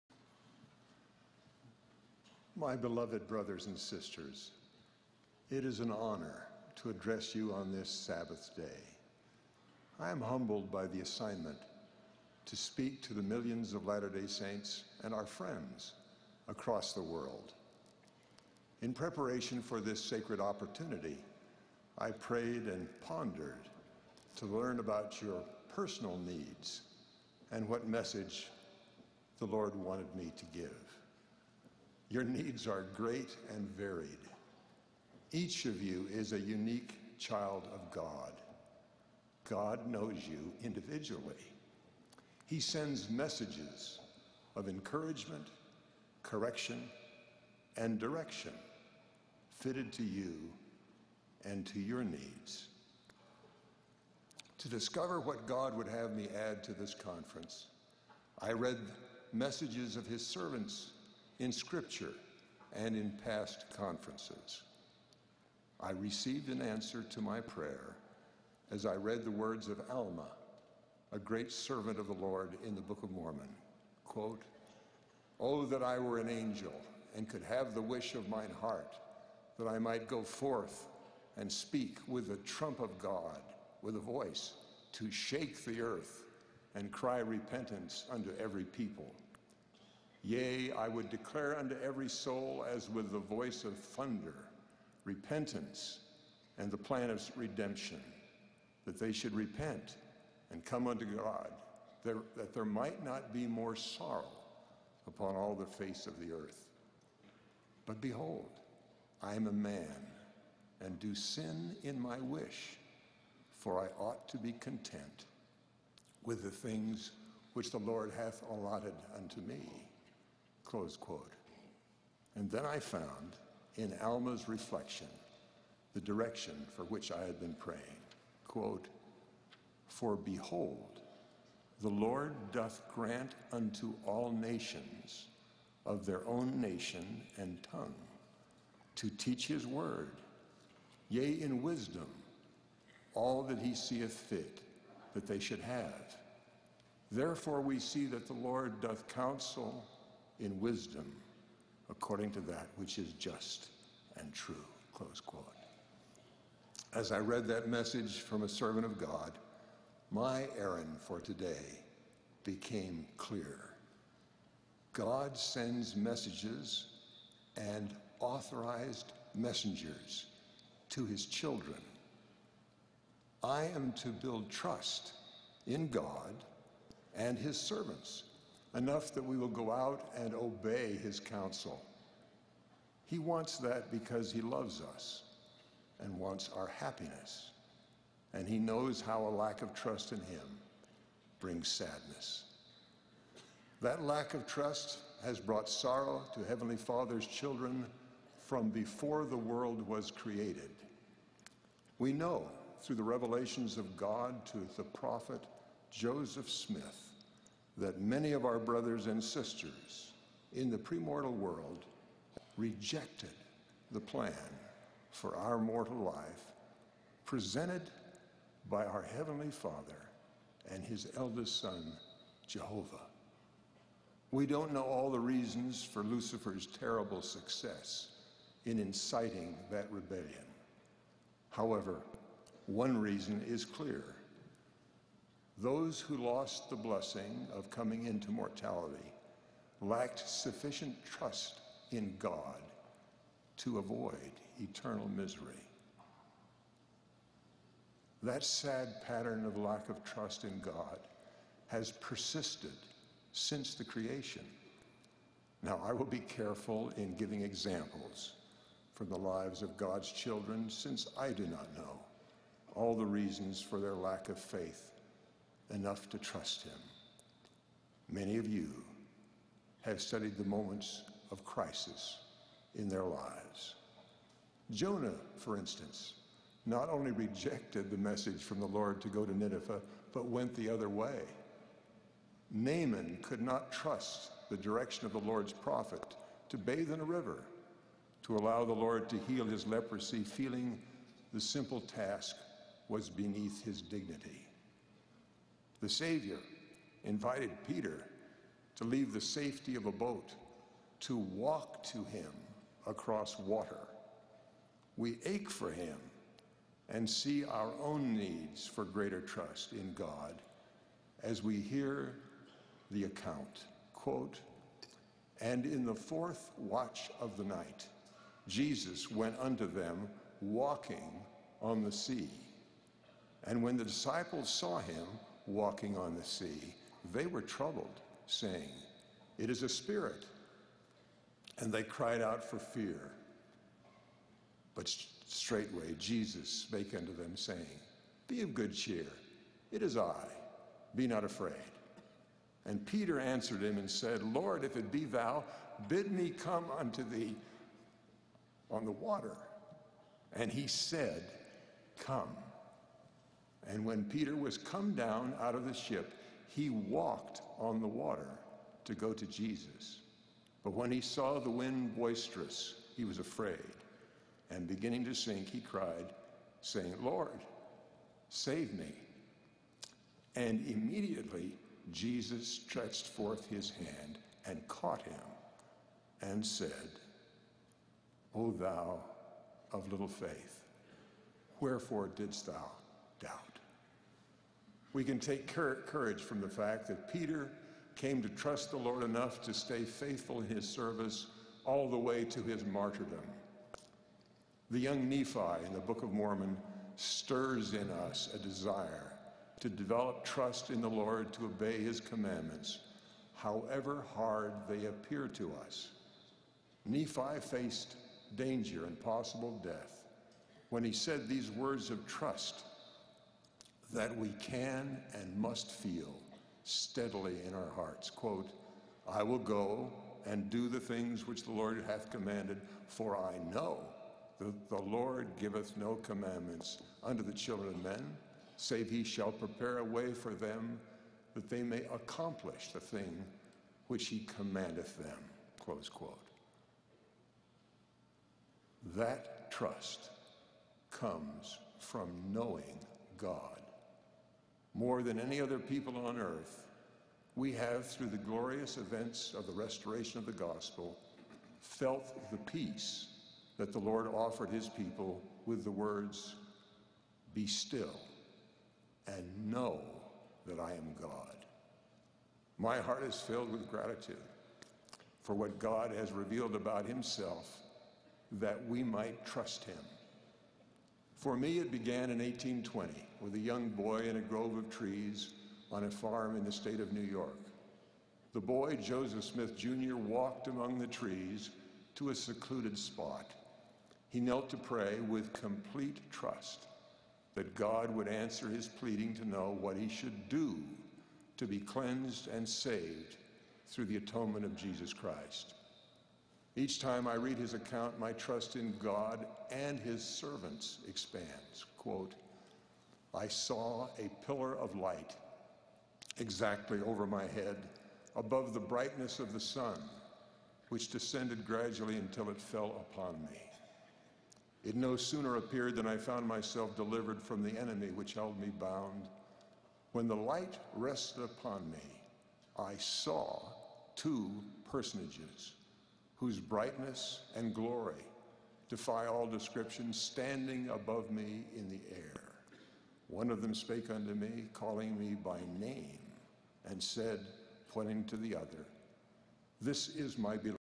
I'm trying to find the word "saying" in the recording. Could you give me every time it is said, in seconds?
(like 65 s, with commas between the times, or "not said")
328 s, 337 s, 366 s.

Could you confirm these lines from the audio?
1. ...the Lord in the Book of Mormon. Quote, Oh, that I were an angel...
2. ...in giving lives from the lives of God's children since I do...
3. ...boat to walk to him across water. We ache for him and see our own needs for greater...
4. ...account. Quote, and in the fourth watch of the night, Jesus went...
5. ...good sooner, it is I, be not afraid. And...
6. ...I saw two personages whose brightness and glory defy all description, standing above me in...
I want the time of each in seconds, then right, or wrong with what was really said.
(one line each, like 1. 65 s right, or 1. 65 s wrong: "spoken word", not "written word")
1. 72 s right
2. 256 s wrong: "examples", not "lives"
3. 299 s right
4. 313 s right
5. 338 s wrong: "cheer", not "sooner"
6. 522 s right.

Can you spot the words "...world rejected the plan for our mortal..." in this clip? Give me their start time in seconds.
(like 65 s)
211 s.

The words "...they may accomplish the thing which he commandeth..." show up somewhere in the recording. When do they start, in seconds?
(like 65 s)
431 s.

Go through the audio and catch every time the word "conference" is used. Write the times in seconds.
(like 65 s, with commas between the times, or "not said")
56 s, 63 s.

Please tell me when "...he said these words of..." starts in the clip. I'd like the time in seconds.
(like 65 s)
410 s.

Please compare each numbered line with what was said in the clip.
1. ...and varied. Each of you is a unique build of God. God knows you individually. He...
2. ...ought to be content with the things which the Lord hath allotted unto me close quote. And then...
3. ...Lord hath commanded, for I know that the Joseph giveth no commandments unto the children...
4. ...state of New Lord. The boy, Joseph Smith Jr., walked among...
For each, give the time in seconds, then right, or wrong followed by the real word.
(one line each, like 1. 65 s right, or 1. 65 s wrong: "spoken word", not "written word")
1. 33 s wrong: "child", not "build"
2. 114 s right
3. 421 s wrong: "Lord", not "Joseph"
4. 476 s wrong: "York", not "Lord".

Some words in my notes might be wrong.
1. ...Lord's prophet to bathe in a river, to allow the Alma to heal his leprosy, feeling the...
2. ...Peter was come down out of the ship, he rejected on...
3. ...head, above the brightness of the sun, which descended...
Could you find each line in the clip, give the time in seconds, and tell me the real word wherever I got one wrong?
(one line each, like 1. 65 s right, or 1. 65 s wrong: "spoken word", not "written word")
1. 285 s wrong: "Lord", not "Alma"
2. 354 s wrong: "walked", not "rejected"
3. 507 s right.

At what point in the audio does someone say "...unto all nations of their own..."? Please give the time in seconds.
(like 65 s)
133 s.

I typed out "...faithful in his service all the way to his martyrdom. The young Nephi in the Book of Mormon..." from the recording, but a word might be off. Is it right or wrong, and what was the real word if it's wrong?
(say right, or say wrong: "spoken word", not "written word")
right.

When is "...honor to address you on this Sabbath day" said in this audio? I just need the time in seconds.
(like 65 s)
5 s.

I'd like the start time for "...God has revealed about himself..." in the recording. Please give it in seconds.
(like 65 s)
465 s.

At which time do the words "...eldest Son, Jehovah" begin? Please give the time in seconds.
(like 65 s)
221 s.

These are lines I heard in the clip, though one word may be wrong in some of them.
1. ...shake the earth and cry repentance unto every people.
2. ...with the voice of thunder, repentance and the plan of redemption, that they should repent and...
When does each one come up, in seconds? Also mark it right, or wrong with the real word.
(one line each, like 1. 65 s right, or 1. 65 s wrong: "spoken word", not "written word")
1. 85 s right
2. 92 s right.